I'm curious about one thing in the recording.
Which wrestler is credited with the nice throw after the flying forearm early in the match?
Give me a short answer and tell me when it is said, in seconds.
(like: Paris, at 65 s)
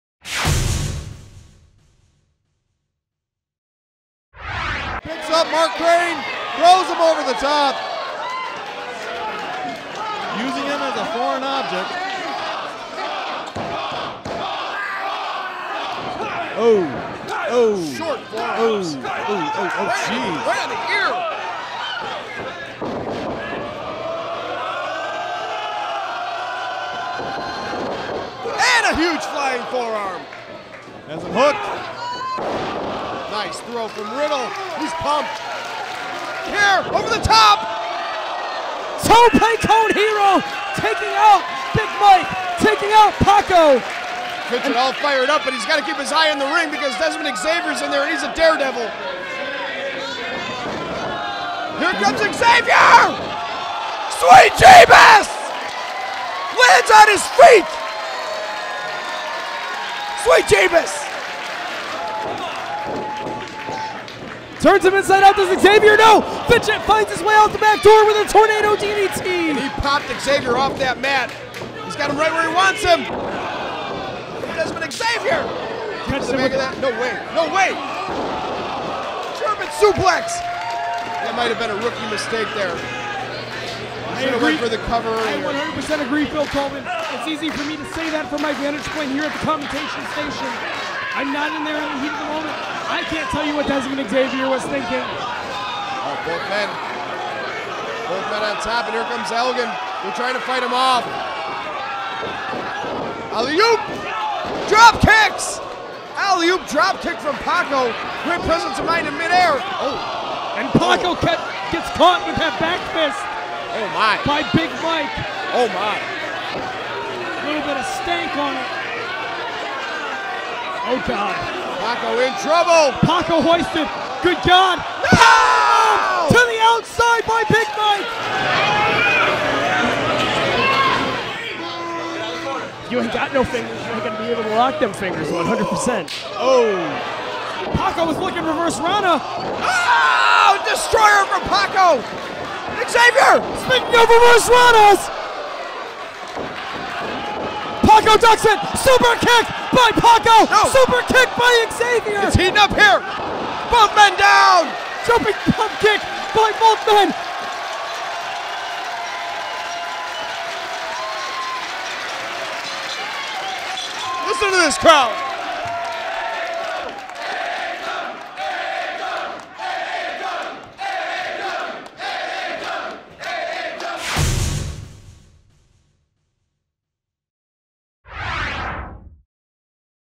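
Riddle, at 34 s.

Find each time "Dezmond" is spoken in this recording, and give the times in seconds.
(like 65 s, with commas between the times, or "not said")
46 s, 74 s, 93 s.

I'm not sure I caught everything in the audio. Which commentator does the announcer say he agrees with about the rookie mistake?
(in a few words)
Phil Tolman.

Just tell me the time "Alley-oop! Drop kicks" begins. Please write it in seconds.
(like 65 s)
103 s.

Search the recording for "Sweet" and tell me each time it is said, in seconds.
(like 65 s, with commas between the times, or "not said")
54 s, 60 s.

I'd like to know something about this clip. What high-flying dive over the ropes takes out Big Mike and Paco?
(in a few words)
Tope con hilo.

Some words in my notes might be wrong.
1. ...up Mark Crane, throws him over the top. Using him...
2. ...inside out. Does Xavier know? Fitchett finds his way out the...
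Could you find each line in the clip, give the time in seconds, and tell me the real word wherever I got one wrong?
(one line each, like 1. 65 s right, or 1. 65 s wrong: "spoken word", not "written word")
1. 5 s right
2. 64 s right.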